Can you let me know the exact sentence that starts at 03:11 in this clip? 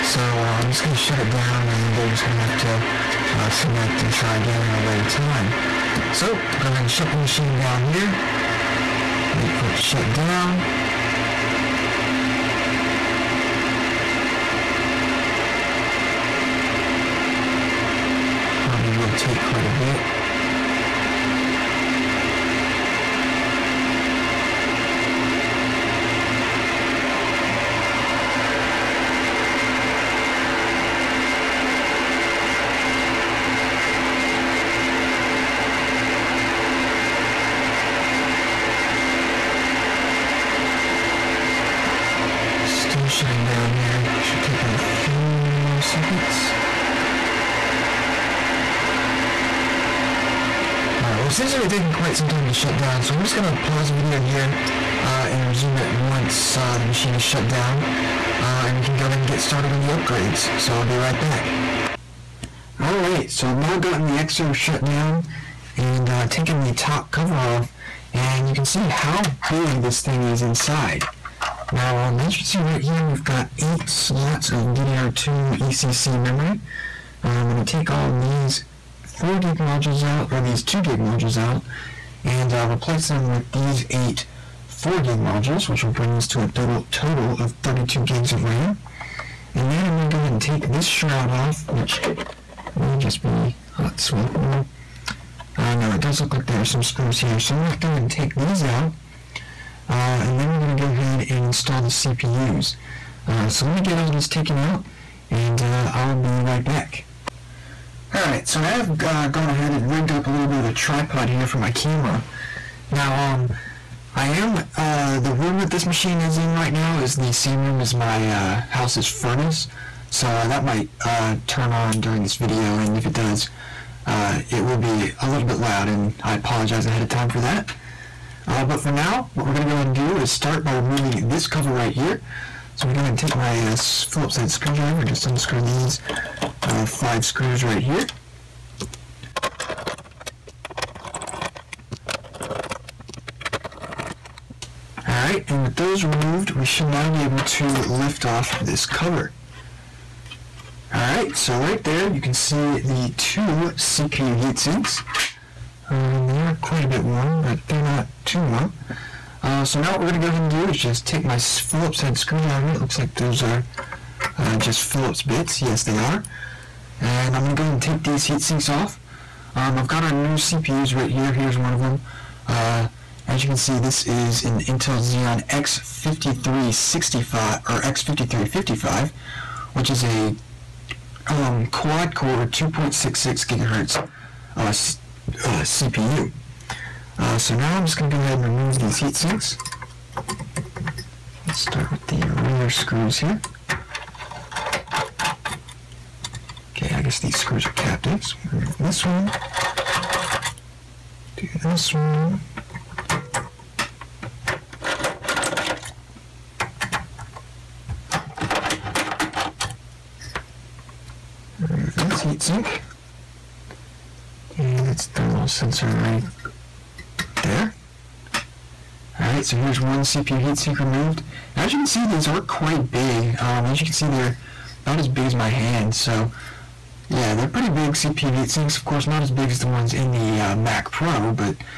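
Let's start with the rear screws here.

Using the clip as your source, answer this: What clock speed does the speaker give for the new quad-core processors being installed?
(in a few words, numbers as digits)
2.66 GHz.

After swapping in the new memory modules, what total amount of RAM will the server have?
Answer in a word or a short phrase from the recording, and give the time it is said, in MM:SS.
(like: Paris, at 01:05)
32 GB, at 01:27.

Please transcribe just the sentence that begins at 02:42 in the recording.
It looks like those are uh, just Phillips bits.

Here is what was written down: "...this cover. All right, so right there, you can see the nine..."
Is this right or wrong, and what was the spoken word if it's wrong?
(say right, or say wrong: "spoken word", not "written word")
wrong: "two", not "nine".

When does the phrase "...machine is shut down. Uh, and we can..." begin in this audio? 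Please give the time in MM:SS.
00:56.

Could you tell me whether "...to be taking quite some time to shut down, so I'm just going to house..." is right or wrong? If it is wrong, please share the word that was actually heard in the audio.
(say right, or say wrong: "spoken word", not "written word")
wrong: "pause", not "house".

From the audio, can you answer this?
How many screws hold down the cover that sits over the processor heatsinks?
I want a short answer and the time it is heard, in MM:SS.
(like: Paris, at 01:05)
5, at 02:16.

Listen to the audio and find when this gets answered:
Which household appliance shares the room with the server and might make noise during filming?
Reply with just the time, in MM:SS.
01:59.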